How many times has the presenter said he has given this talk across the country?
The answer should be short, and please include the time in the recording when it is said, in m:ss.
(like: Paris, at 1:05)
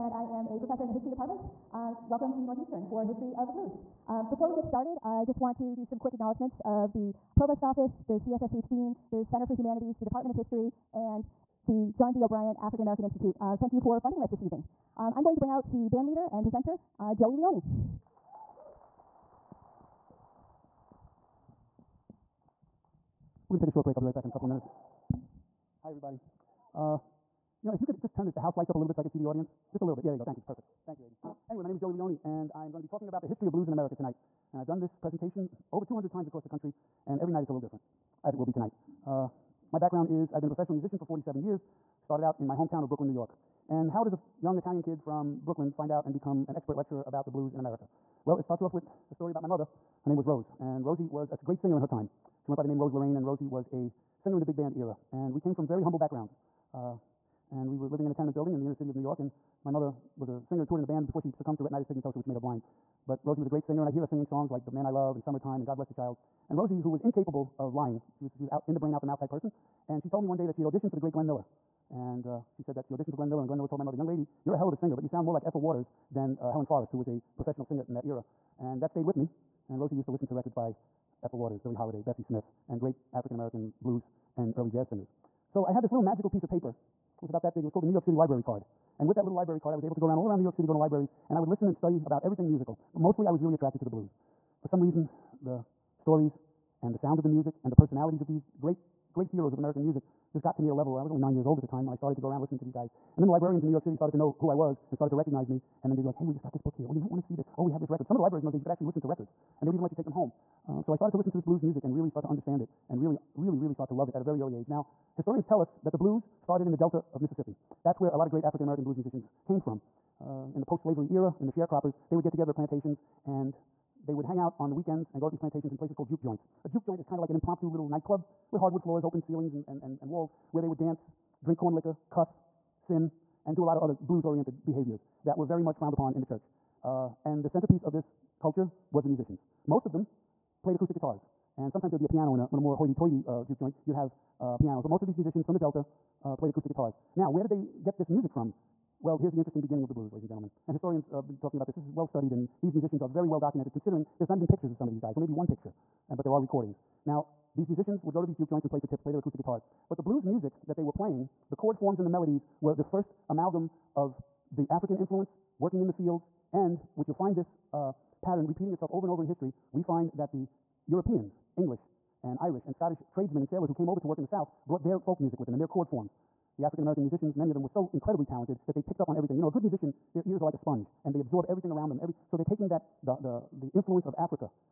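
over 200, at 0:35.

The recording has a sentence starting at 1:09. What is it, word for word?
And she told me one day that she had auditioned for the great Glenn Miller.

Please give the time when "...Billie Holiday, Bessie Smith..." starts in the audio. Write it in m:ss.
1:21.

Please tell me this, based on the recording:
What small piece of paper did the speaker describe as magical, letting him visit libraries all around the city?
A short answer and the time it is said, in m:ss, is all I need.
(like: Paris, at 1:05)
New York City Library Card, at 1:27.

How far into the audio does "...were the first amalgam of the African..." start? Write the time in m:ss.
2:42.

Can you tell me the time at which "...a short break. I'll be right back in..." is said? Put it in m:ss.
0:23.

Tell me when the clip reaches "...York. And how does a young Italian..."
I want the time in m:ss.
0:43.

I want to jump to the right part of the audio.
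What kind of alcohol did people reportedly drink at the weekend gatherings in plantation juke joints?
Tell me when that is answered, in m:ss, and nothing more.
2:11.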